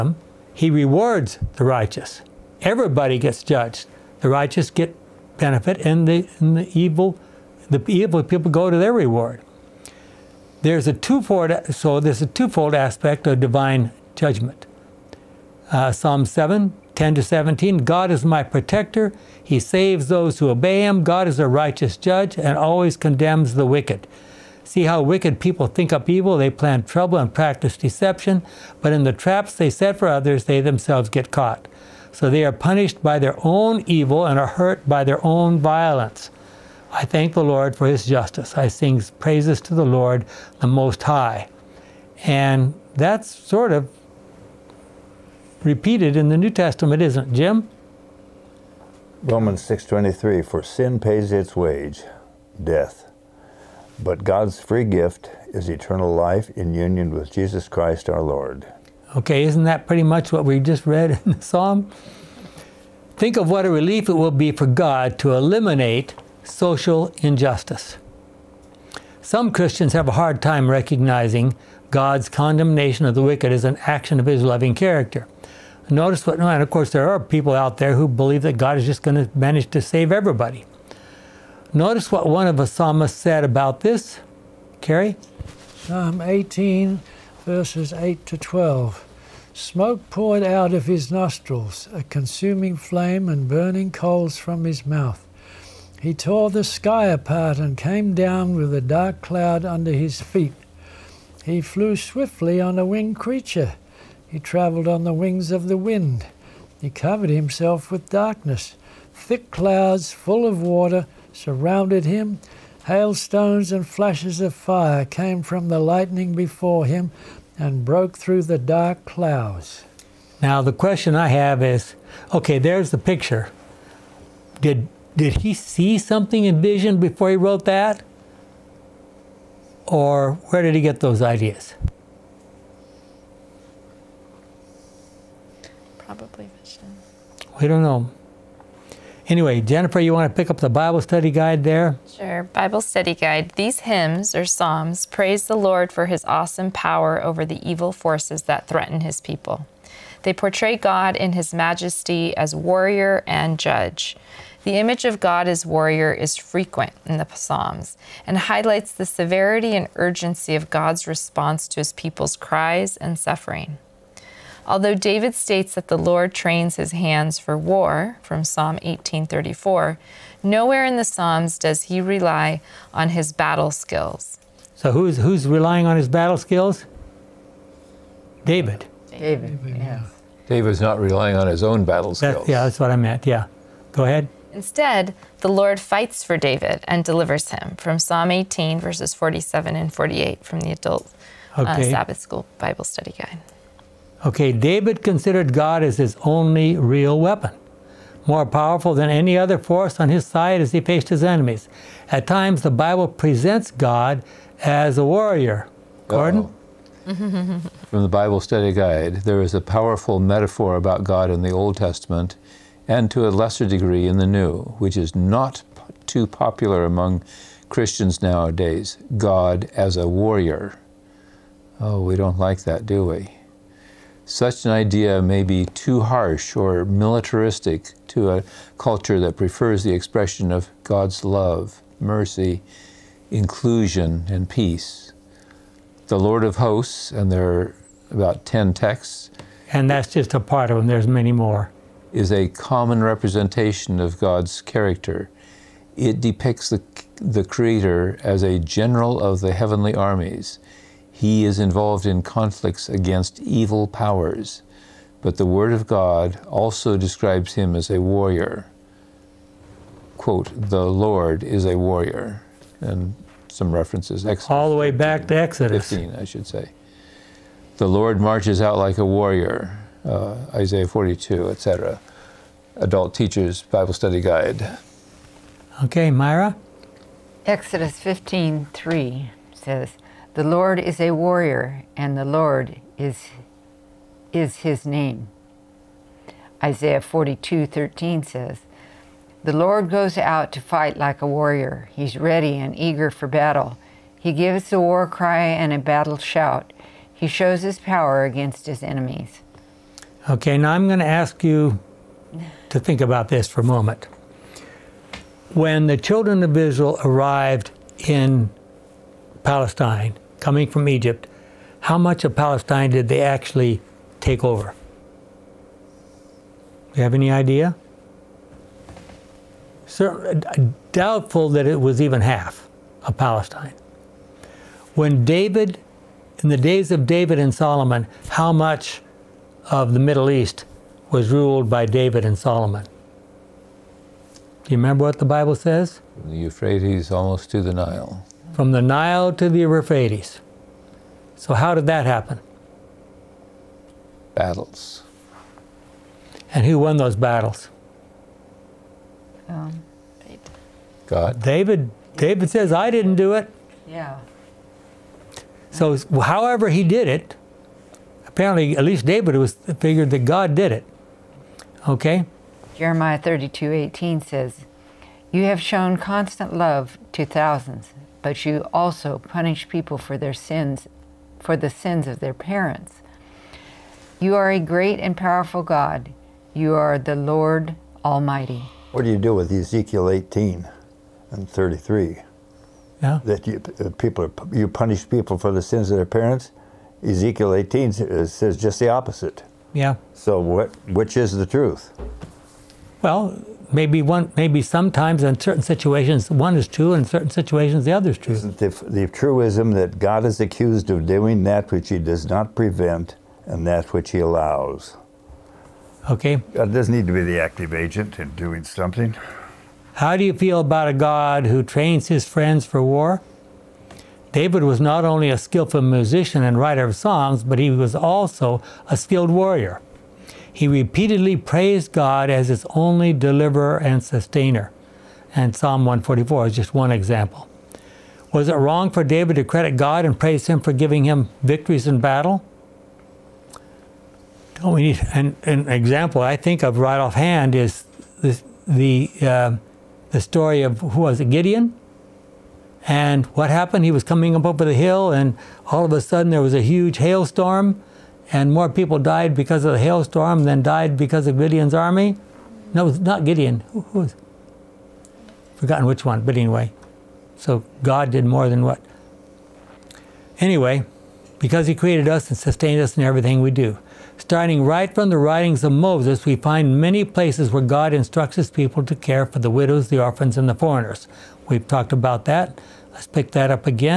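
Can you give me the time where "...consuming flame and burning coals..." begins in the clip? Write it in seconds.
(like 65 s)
92 s.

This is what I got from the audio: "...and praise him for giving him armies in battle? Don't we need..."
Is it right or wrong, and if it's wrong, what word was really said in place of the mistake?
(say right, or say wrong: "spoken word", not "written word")
wrong: "victories", not "armies".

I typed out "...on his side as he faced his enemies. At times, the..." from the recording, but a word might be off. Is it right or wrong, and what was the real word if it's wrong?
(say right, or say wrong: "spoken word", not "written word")
right.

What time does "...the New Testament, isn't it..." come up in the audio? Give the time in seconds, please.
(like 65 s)
46 s.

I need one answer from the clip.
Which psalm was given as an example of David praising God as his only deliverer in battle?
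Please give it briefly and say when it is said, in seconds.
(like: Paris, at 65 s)
Psalm 144, at 425 s.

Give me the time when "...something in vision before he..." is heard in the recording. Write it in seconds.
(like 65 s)
125 s.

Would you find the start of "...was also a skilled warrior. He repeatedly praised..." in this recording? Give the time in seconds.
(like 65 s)
417 s.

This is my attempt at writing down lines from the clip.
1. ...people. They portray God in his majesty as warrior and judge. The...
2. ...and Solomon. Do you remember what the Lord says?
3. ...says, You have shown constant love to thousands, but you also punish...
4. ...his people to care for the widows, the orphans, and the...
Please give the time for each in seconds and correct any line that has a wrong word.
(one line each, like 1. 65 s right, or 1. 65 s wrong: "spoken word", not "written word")
1. 149 s right
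2. 332 s wrong: "Bible", not "Lord"
3. 364 s right
4. 468 s right.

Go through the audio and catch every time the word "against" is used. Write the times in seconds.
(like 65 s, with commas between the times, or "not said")
252 s, 298 s.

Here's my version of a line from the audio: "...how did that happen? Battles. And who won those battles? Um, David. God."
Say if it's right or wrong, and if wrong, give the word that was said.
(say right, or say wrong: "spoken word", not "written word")
right.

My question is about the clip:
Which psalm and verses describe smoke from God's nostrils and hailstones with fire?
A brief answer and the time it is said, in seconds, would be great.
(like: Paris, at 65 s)
Psalm 18:8-12, at 85 s.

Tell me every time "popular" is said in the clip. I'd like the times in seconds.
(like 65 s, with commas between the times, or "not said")
216 s.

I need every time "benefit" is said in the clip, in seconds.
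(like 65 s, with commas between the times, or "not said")
5 s.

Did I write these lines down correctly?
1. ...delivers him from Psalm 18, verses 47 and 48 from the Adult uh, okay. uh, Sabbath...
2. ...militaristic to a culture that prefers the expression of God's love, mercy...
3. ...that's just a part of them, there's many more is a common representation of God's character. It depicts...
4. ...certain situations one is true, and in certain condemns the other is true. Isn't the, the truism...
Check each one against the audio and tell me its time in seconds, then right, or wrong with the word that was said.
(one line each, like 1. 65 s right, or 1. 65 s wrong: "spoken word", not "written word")
1. 187 s right
2. 226 s right
3. 239 s right
4. 395 s wrong: "situations", not "condemns".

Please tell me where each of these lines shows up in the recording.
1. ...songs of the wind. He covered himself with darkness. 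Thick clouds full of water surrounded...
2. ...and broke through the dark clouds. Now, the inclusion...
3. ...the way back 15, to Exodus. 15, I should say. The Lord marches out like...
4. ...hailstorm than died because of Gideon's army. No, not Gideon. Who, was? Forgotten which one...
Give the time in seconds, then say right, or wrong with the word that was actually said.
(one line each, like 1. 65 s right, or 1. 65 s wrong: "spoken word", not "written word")
1. 105 s wrong: "wings", not "songs"
2. 117 s wrong: "question", not "inclusion"
3. 264 s right
4. 449 s right.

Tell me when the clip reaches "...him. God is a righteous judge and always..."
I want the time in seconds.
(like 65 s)
20 s.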